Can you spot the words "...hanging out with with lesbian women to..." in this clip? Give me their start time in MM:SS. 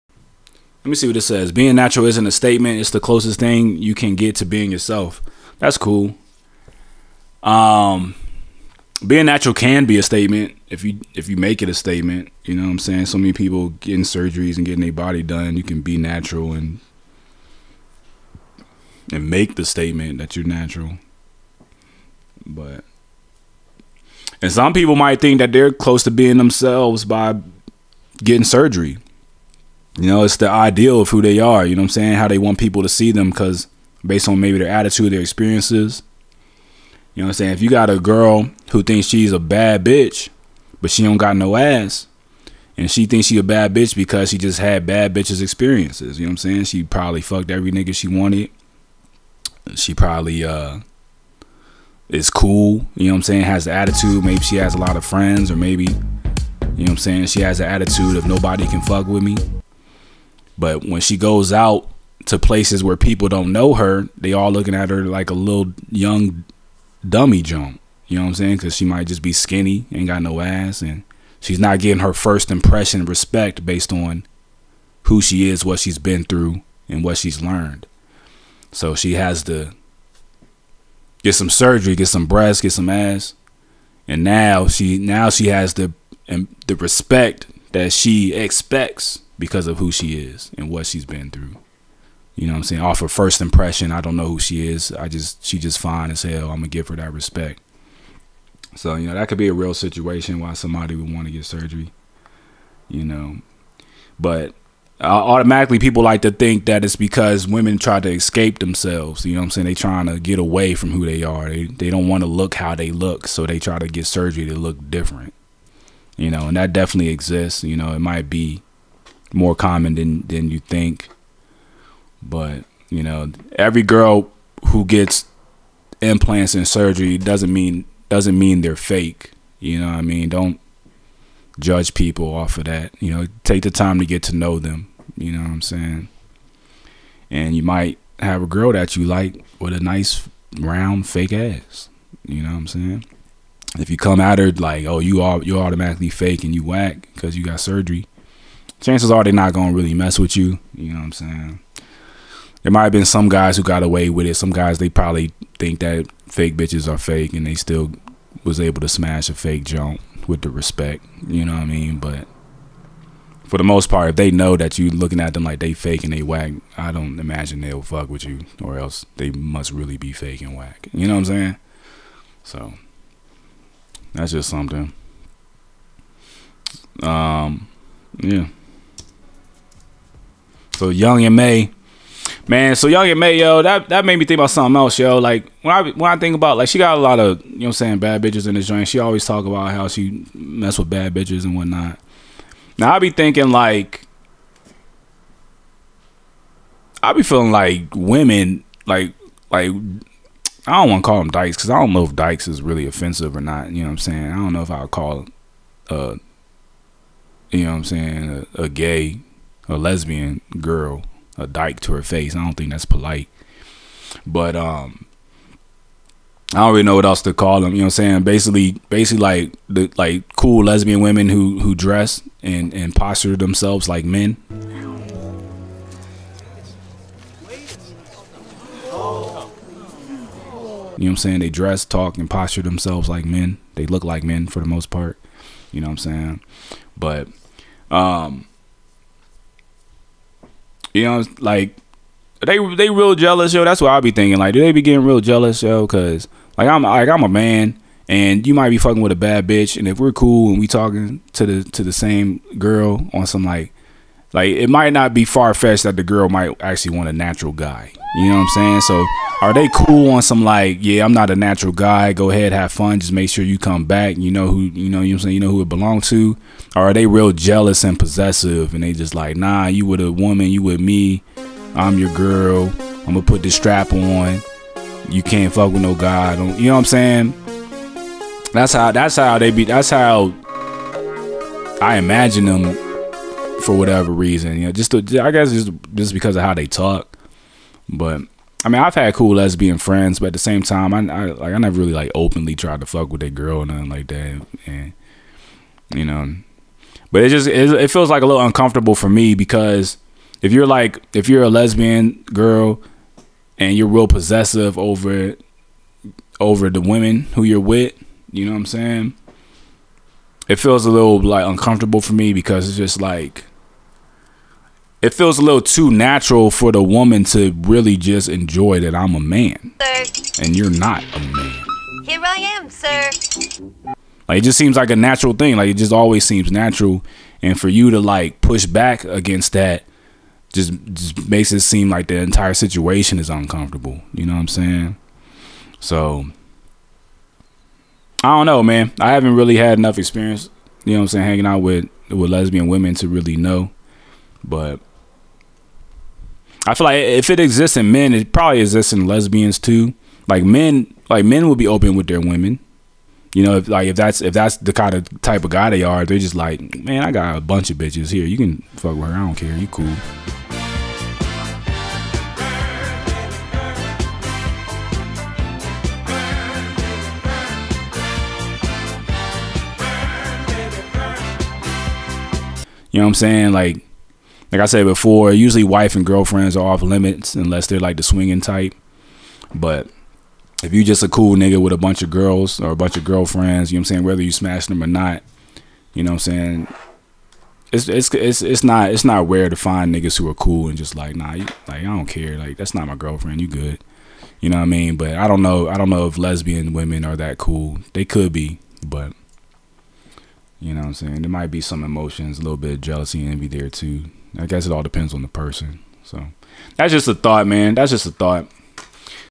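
05:41.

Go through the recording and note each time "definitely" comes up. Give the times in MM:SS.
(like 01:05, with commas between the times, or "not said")
01:56.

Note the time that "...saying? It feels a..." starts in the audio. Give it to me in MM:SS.
05:08.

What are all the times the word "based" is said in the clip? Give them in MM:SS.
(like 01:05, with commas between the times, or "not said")
00:34, 01:13.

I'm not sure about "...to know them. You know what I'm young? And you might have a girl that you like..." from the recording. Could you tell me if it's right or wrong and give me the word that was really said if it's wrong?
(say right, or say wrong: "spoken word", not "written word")
wrong: "saying", not "young".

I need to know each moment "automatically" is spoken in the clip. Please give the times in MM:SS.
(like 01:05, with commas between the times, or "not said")
01:45, 02:25.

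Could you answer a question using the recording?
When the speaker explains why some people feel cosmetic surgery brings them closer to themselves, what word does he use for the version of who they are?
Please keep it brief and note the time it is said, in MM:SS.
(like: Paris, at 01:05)
ideal, at 00:30.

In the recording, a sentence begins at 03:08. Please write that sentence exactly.
She always talk about how she mess with bad bitches and whatnot.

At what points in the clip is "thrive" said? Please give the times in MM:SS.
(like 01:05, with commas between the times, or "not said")
not said.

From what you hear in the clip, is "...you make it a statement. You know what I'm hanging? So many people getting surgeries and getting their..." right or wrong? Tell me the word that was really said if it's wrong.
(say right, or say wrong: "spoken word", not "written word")
wrong: "saying", not "hanging".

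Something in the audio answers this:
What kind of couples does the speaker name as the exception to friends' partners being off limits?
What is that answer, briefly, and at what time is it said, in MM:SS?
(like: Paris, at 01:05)
swinging type, at 06:18.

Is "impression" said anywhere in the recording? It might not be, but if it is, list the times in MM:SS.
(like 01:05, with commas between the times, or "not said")
01:12, 01:33.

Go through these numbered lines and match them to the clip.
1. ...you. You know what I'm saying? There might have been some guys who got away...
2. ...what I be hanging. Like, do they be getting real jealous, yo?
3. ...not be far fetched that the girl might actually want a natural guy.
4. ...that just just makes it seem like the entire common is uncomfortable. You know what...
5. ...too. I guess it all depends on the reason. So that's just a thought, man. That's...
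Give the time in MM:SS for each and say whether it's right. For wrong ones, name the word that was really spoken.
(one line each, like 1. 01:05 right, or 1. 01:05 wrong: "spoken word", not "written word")
1. 02:30 right
2. 04:03 wrong: "thinking", not "hanging"
3. 04:14 right
4. 05:29 wrong: "situation", not "common"
5. 06:43 wrong: "person", not "reason".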